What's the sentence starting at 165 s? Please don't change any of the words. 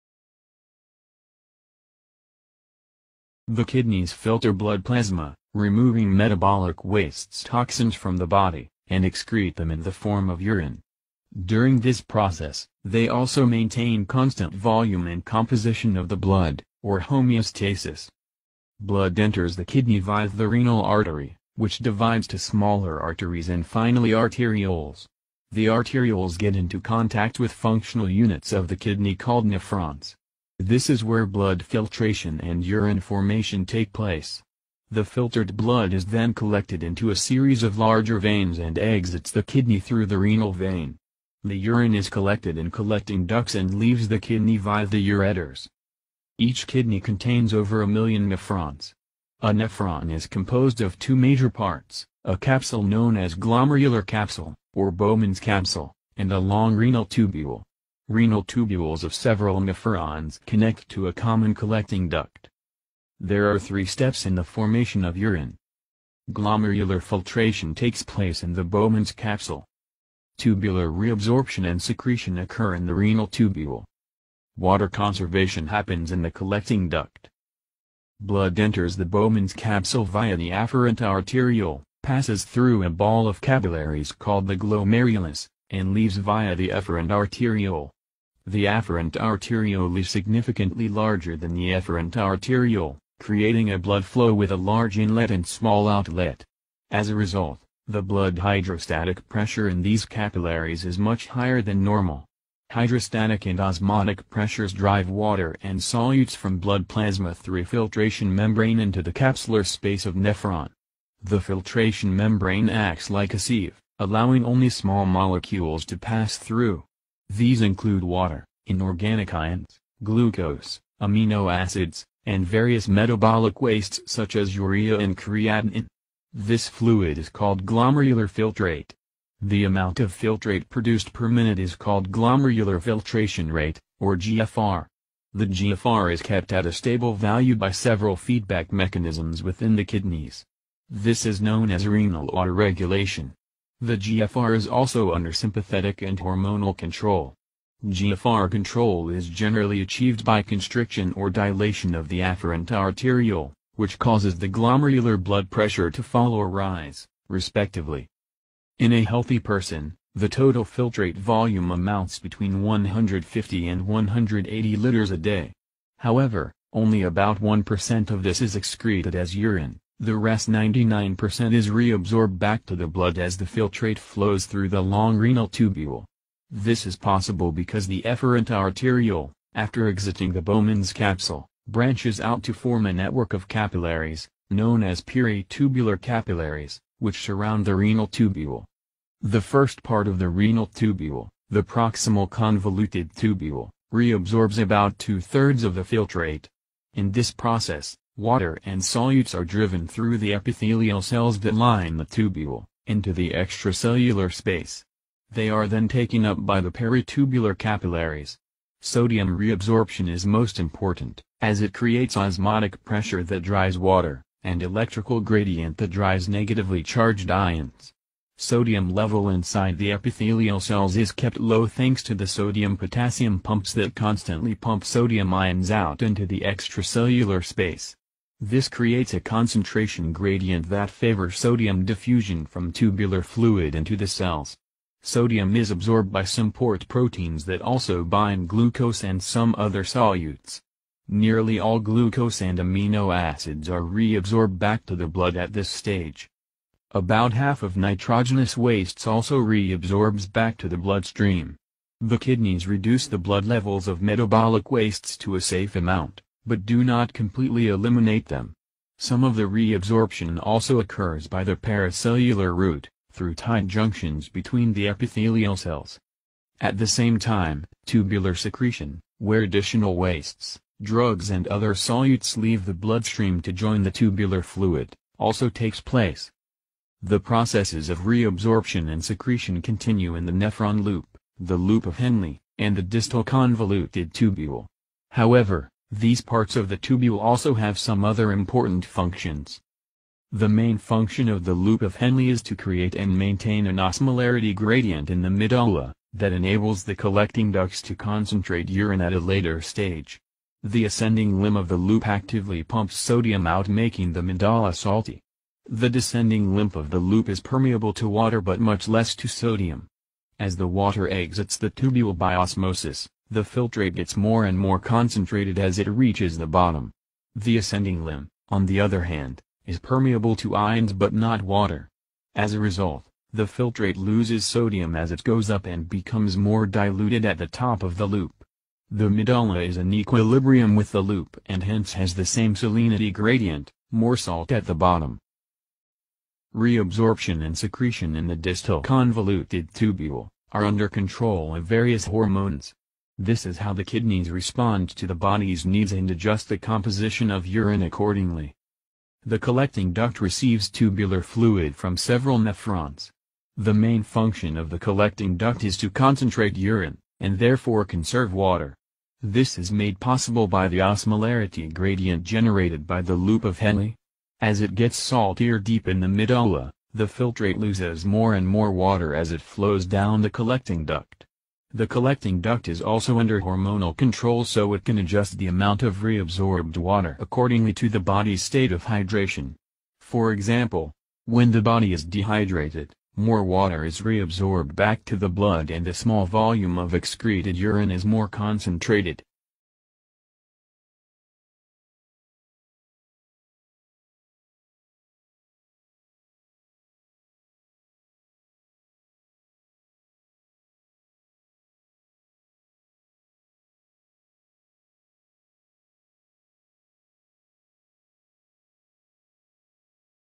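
However, only about 1% of this is excreted as urine.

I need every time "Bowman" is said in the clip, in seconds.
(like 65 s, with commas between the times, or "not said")
54 s, 68 s, 79 s, 180 s.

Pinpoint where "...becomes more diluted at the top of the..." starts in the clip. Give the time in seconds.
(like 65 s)
325 s.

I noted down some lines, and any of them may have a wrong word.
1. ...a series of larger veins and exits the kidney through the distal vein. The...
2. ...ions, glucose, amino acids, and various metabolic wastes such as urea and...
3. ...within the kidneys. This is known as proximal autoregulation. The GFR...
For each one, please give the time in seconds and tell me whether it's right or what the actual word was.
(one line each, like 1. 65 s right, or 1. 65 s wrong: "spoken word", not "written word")
1. 37 s wrong: "renal", not "distal"
2. 119 s right
3. 139 s wrong: "renal", not "proximal".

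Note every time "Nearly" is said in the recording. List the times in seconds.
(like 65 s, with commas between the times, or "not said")
241 s.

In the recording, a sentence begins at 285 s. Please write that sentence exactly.
However, these parts of the tubule also have some other important functions.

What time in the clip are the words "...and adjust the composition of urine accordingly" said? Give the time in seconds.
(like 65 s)
345 s.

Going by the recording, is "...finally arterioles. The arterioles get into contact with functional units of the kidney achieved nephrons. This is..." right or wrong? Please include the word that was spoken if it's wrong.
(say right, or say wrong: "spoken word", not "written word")
wrong: "called", not "achieved".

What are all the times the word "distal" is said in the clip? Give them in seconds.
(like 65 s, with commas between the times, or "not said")
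282 s, 338 s.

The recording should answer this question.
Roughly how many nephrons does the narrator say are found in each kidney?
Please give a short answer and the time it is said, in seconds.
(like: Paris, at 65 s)
over a million, at 47 s.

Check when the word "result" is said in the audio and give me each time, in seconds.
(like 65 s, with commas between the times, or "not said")
97 s, 322 s.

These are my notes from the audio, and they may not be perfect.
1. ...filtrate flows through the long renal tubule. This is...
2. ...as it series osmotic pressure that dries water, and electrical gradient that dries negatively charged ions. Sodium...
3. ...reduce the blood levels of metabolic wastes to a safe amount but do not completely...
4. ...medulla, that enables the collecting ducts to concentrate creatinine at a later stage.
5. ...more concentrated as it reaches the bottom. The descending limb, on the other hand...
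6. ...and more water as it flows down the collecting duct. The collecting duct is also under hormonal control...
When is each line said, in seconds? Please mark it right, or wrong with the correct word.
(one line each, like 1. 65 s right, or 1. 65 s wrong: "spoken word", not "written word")
1. 173 s right
2. 211 s wrong: "creates", not "series"
3. 252 s right
4. 295 s wrong: "urine", not "creatinine"
5. 314 s wrong: "ascending", not "descending"
6. 368 s right.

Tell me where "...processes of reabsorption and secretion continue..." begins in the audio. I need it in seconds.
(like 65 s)
277 s.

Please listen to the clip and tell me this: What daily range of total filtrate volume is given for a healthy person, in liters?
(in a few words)
150 to 180 liters.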